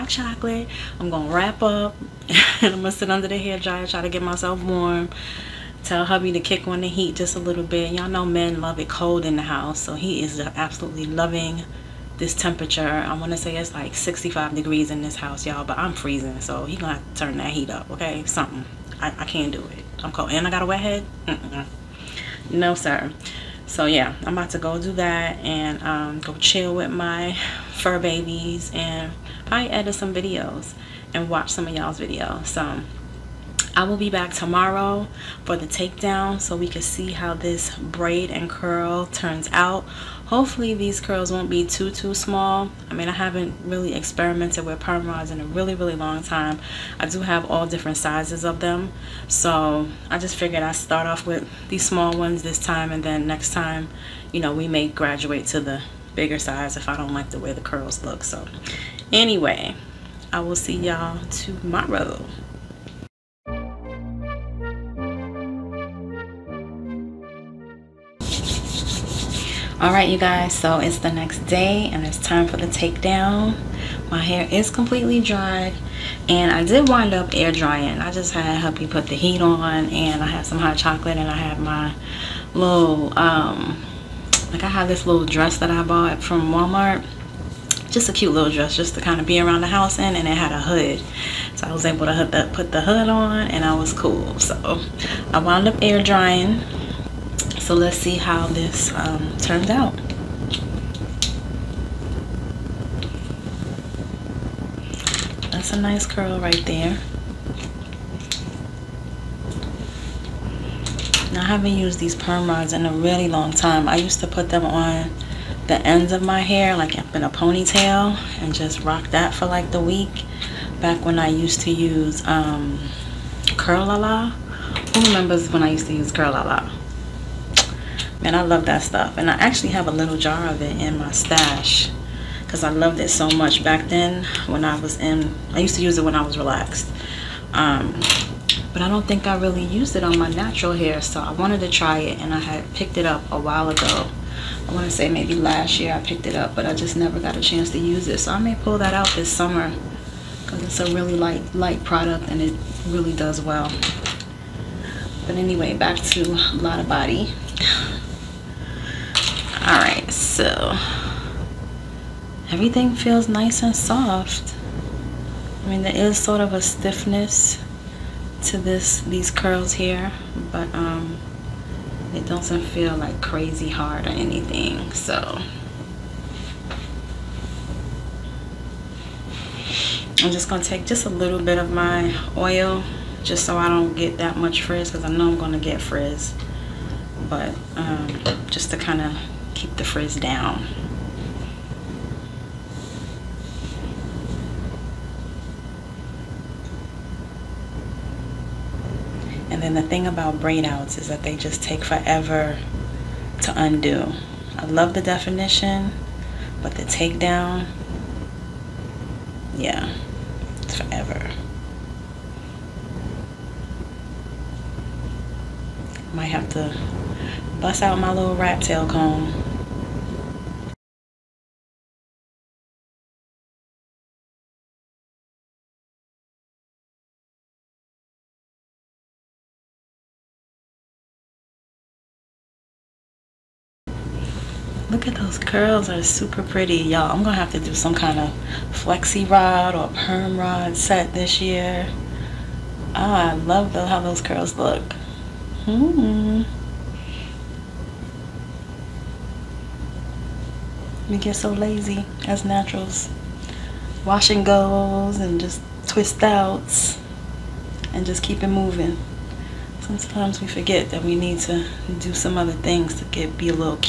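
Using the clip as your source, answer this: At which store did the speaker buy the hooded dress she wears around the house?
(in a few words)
Walmart.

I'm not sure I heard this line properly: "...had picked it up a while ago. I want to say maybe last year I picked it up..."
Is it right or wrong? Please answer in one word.
right.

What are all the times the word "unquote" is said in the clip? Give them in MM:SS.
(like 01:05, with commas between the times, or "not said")
not said.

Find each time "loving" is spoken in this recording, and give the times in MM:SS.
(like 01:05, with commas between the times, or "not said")
00:11.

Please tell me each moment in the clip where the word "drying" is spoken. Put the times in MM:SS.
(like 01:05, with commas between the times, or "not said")
01:17, 01:36.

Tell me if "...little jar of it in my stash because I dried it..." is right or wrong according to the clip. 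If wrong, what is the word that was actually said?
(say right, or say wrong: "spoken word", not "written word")
wrong: "loved", not "dried".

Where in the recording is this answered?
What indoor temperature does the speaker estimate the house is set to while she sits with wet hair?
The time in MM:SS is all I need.
00:13.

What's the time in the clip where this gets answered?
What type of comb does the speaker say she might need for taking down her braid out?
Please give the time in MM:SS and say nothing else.
03:38.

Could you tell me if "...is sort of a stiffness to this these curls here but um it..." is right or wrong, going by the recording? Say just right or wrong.
right.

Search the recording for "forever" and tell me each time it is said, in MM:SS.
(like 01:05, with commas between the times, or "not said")
03:21, 03:30.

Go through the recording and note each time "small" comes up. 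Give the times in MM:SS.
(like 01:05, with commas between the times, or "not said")
00:42, 00:51.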